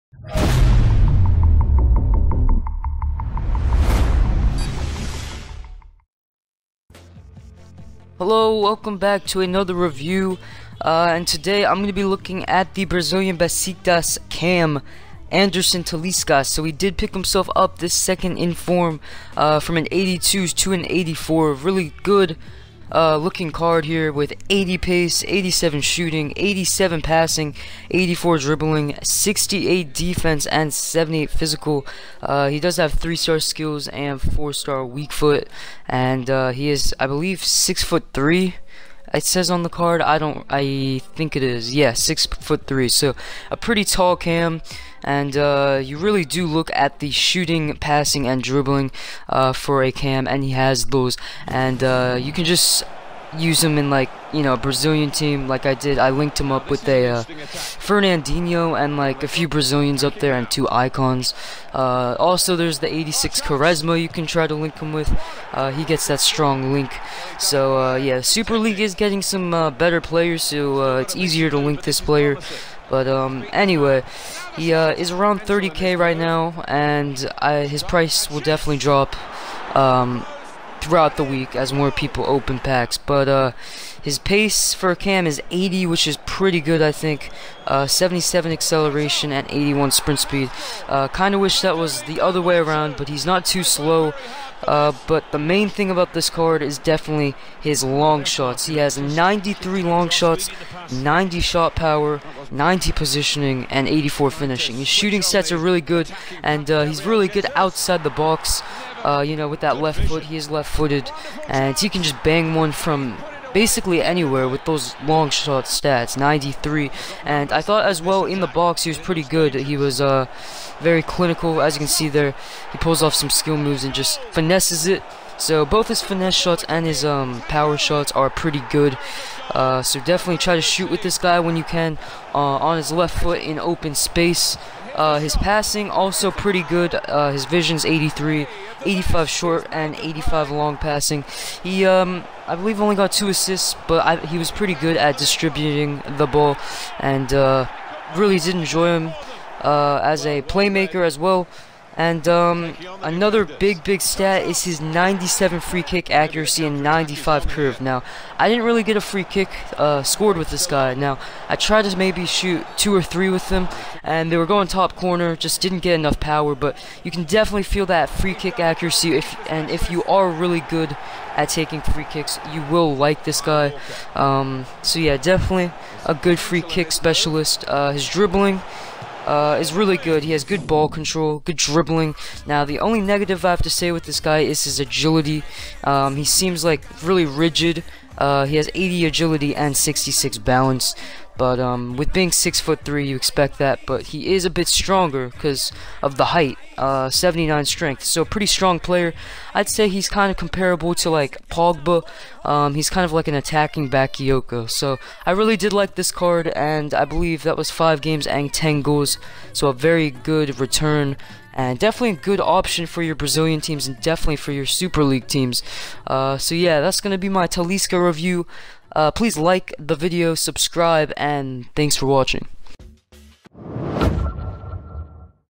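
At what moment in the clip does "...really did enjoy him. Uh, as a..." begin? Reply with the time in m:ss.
2:28.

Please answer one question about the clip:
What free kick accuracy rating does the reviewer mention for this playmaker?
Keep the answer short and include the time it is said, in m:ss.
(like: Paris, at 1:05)
97, at 2:34.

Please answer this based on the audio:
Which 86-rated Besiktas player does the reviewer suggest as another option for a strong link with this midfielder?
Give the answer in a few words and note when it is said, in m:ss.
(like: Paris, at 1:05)
Quaresma, at 1:03.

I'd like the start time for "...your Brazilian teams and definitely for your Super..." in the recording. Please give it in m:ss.
3:33.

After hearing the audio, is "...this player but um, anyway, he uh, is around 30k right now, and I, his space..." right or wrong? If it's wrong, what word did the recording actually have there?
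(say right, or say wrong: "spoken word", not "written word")
wrong: "price", not "space".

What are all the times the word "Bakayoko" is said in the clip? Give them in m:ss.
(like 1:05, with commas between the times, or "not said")
3:23.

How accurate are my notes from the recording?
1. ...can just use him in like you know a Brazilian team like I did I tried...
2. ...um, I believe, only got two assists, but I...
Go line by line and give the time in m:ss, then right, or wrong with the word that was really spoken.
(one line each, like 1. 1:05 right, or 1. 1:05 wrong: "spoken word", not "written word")
1. 0:52 wrong: "linked", not "tried"
2. 2:21 right.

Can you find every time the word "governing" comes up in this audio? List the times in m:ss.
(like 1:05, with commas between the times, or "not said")
not said.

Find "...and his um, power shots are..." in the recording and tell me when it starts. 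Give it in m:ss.
2:06.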